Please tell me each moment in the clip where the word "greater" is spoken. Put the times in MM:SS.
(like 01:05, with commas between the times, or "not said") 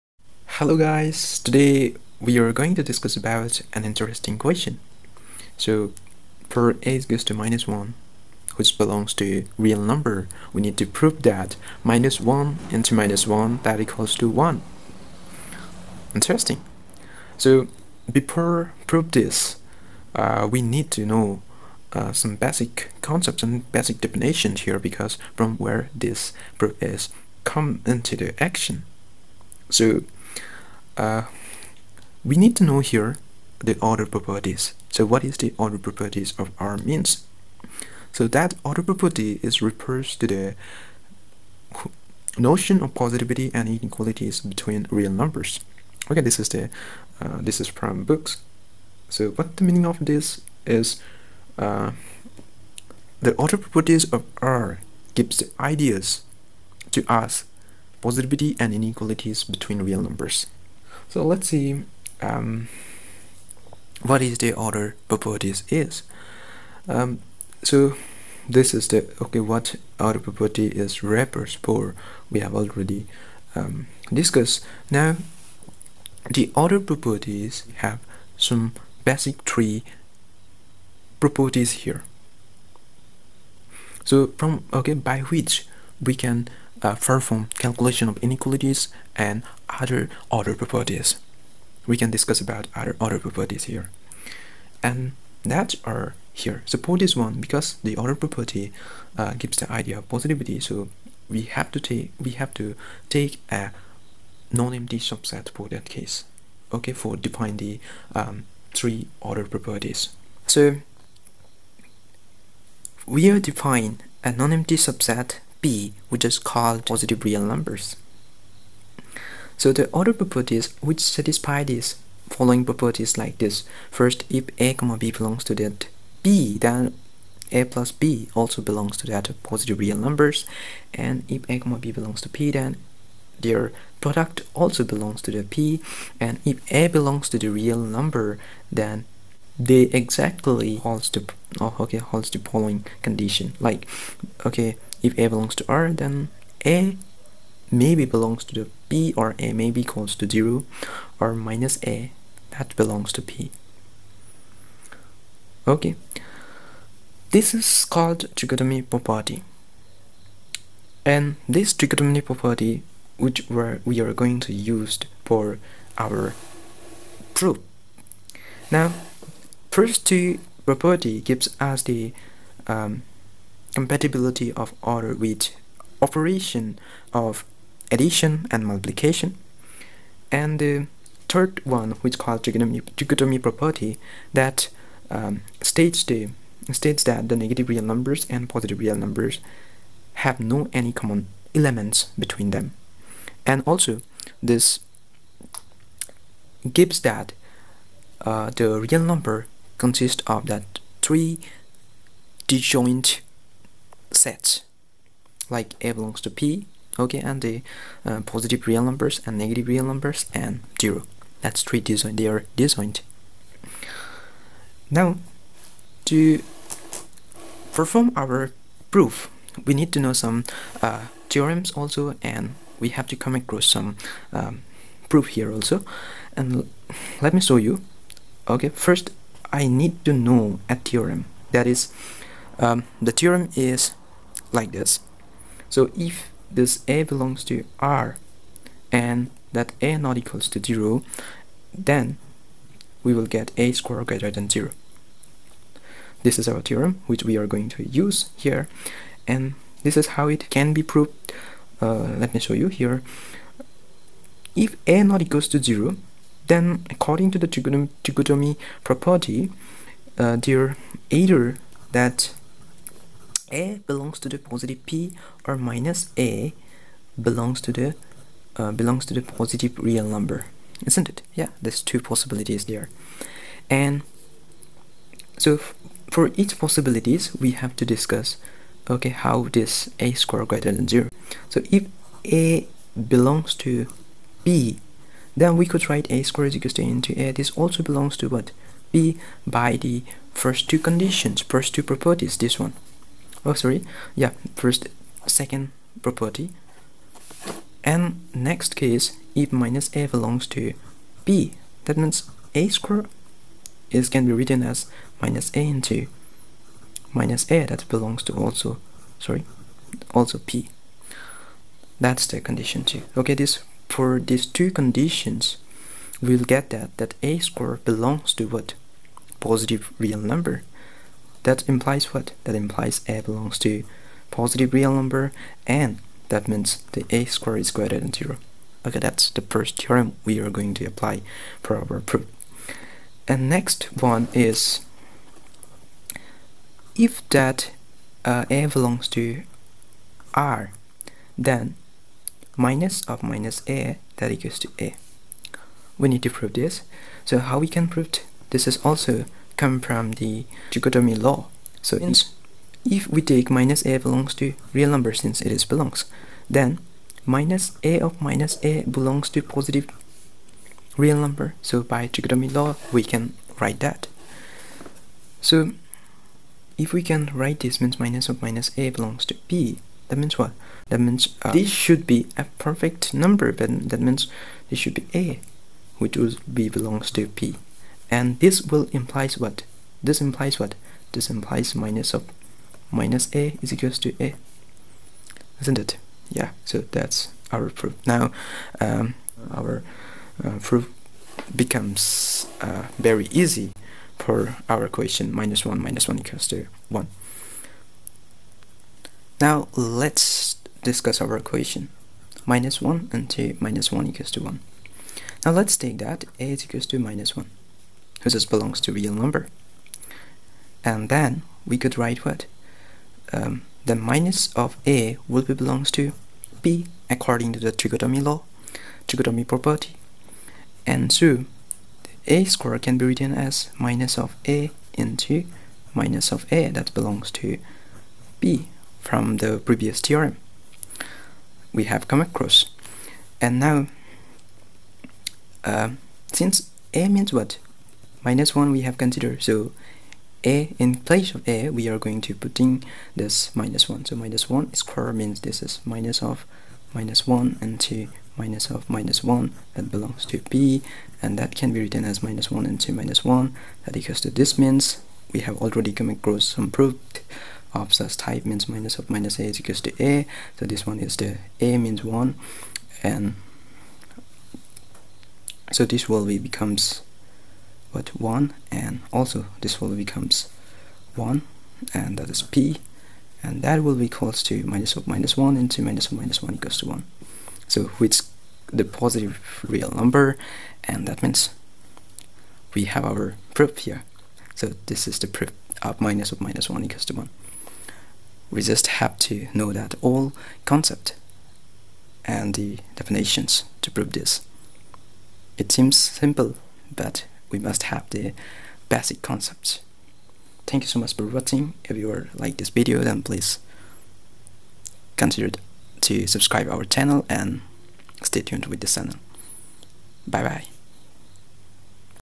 04:04, 04:40, 05:27.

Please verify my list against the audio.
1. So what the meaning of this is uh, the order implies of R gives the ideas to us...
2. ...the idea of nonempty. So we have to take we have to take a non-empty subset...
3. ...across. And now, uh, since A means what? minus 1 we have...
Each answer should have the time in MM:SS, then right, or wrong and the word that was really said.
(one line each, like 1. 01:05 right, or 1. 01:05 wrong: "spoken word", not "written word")
1. 00:49 wrong: "properties", not "implies"
2. 01:39 wrong: "positivity", not "nonempty"
3. 07:12 right.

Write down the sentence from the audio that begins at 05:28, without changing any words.
Okay, that's the first theorem we are going to apply for our proof.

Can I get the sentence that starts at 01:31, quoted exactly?
We can discuss about other order properties here.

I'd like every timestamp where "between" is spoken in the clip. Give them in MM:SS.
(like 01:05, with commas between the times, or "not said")
00:44, 00:59, 03:12.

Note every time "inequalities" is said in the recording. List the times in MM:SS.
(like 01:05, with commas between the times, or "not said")
00:43, 00:58, 01:28.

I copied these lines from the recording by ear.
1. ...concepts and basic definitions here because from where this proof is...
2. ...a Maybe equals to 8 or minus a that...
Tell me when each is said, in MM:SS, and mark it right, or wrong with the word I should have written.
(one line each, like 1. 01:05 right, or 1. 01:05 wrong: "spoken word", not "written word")
1. 00:23 right
2. 02:29 wrong: "0", not "8".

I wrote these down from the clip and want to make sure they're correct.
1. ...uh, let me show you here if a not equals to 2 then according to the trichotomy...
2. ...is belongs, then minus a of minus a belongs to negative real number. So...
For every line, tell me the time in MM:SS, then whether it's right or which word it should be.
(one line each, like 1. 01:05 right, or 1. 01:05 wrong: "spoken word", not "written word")
1. 04:11 wrong: "0", not "2"
2. 05:55 wrong: "positive", not "negative".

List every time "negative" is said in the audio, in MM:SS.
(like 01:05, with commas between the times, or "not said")
03:07, 03:29.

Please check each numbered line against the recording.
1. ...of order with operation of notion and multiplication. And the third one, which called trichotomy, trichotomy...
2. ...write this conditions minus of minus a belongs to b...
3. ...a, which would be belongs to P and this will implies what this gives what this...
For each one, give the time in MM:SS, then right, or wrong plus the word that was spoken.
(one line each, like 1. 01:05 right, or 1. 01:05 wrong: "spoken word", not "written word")
1. 02:54 wrong: "addition", not "notion"
2. 06:07 wrong: "means", not "conditions"
3. 06:15 wrong: "implies", not "gives".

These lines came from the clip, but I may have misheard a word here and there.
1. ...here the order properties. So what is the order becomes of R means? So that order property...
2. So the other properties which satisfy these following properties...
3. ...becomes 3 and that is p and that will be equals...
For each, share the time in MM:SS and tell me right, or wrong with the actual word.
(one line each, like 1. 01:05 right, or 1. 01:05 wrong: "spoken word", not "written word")
1. 00:32 wrong: "properties", not "becomes"
2. 01:59 right
3. 07:49 wrong: "1", not "3".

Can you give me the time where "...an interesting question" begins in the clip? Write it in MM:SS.
00:03.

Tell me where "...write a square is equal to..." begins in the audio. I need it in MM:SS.
04:45.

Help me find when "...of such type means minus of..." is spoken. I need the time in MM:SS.
07:37.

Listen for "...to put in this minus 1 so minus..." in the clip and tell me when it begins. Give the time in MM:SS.
07:22.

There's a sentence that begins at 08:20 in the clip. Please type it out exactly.
Thank you so much for watching.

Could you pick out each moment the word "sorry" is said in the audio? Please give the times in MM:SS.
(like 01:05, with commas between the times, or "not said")
04:53, 05:09.